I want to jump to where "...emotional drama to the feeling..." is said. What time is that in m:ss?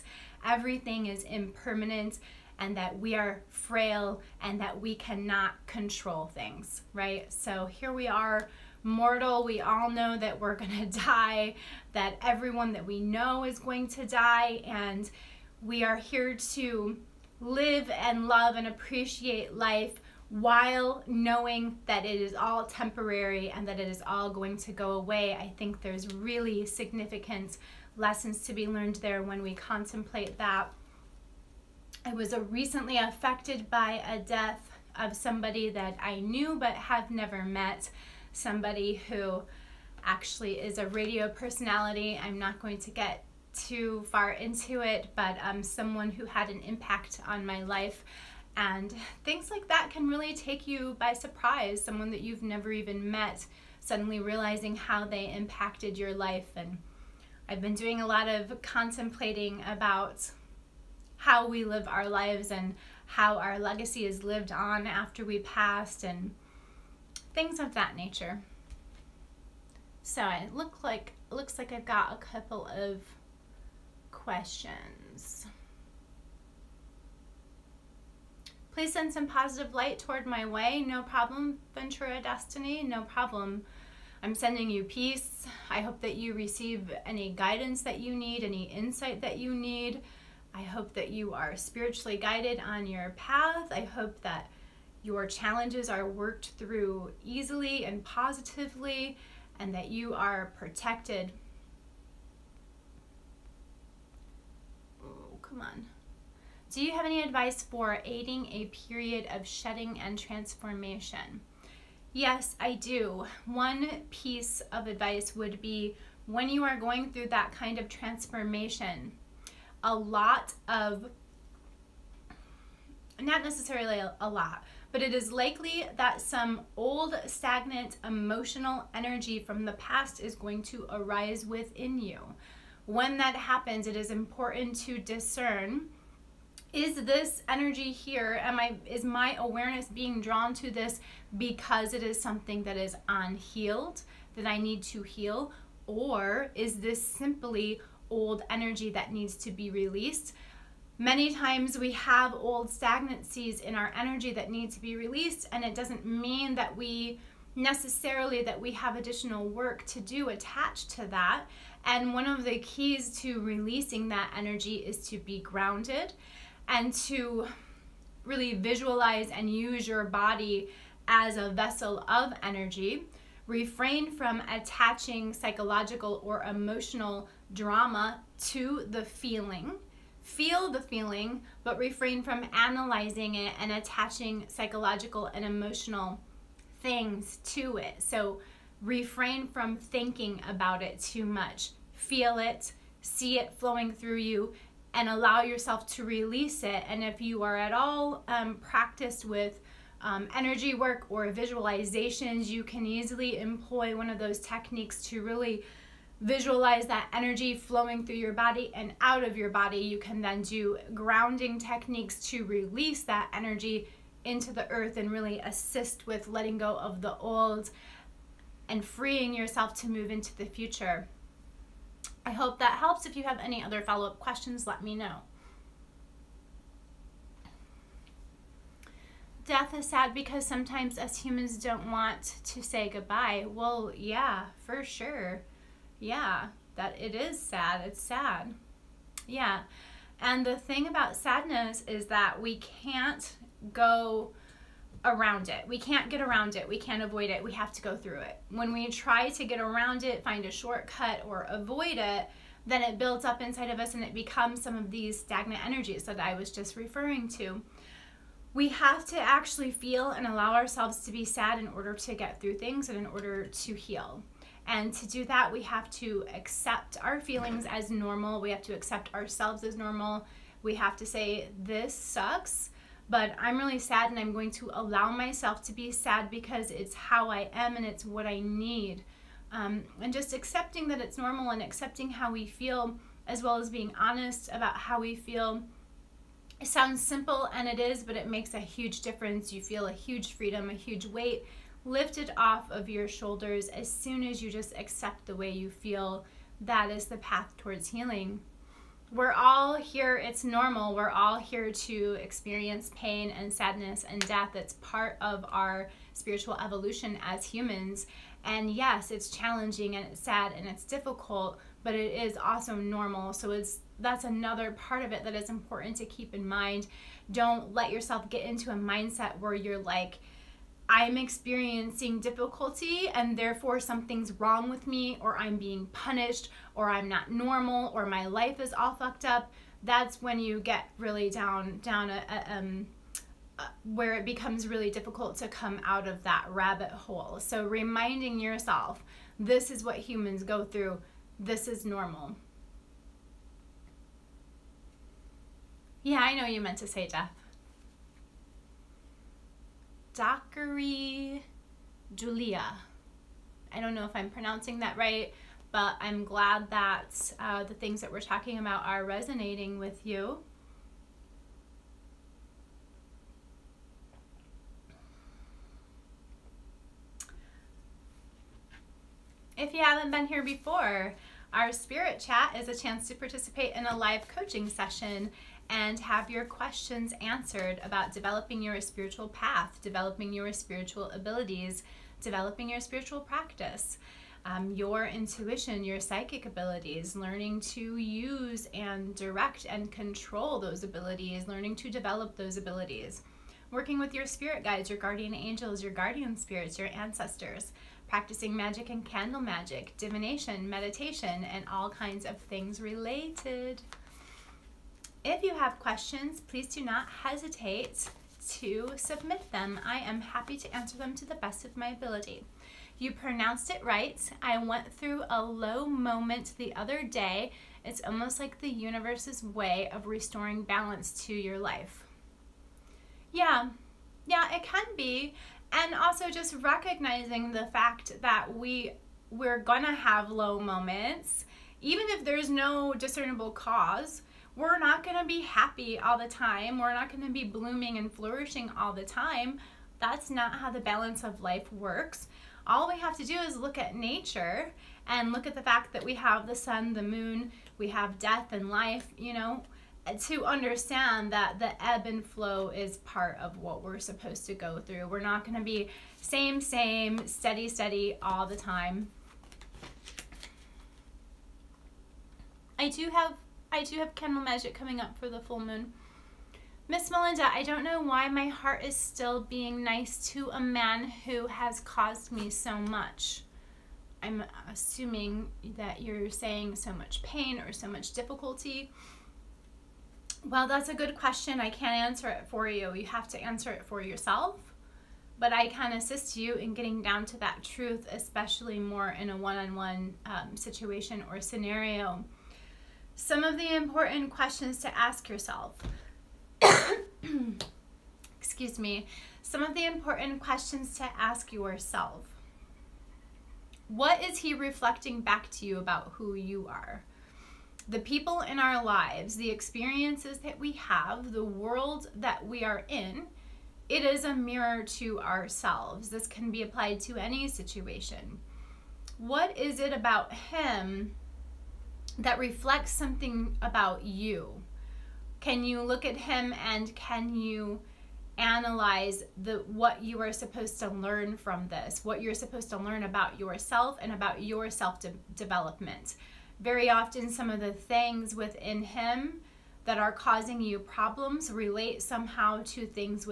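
2:56.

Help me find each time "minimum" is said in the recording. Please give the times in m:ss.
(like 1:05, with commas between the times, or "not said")
not said.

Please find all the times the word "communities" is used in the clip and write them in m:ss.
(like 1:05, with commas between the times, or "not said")
not said.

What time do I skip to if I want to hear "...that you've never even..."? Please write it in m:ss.
0:52.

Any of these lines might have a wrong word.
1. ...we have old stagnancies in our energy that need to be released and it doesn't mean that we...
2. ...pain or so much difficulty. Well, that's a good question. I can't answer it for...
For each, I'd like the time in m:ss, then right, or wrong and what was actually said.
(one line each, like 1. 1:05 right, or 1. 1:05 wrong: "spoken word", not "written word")
1. 2:31 right
2. 7:57 right.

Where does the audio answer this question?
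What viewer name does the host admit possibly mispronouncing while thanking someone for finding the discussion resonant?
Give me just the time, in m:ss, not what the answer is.
5:50.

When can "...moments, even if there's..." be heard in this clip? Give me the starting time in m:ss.
7:10.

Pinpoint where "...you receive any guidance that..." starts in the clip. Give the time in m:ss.
1:26.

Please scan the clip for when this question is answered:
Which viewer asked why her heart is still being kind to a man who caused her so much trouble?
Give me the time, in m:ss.
7:46.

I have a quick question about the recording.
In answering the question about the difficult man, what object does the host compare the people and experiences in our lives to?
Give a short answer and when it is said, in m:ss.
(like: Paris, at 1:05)
A mirror, at 8:34.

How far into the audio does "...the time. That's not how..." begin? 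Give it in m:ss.
7:18.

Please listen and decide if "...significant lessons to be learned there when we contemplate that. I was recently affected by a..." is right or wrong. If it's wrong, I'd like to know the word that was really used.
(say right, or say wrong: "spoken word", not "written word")
right.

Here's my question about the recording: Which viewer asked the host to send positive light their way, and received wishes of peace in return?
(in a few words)
Ventura Destiny.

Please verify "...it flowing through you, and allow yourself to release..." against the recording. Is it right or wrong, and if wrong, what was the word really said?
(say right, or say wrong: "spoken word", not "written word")
right.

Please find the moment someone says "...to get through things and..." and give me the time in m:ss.
4:21.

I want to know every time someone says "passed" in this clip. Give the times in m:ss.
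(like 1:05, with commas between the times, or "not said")
1:05.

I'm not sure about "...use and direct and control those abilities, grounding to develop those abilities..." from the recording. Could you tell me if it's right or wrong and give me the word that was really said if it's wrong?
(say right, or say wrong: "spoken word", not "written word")
wrong: "learning", not "grounding".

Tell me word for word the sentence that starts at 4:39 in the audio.
Um, and just accepting that it's normal and accepting how we feel, as well as being honest about how we feel.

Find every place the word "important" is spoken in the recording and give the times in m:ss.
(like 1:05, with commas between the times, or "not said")
2:14, 5:15, 8:13, 8:19.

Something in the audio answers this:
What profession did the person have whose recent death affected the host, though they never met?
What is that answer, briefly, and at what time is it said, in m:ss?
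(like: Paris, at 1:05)
Radio personality, at 0:40.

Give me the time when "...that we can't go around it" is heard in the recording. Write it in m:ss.
4:02.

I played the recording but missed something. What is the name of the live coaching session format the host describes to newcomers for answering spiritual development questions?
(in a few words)
Spirit chat.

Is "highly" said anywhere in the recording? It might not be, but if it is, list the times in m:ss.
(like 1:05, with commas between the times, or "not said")
not said.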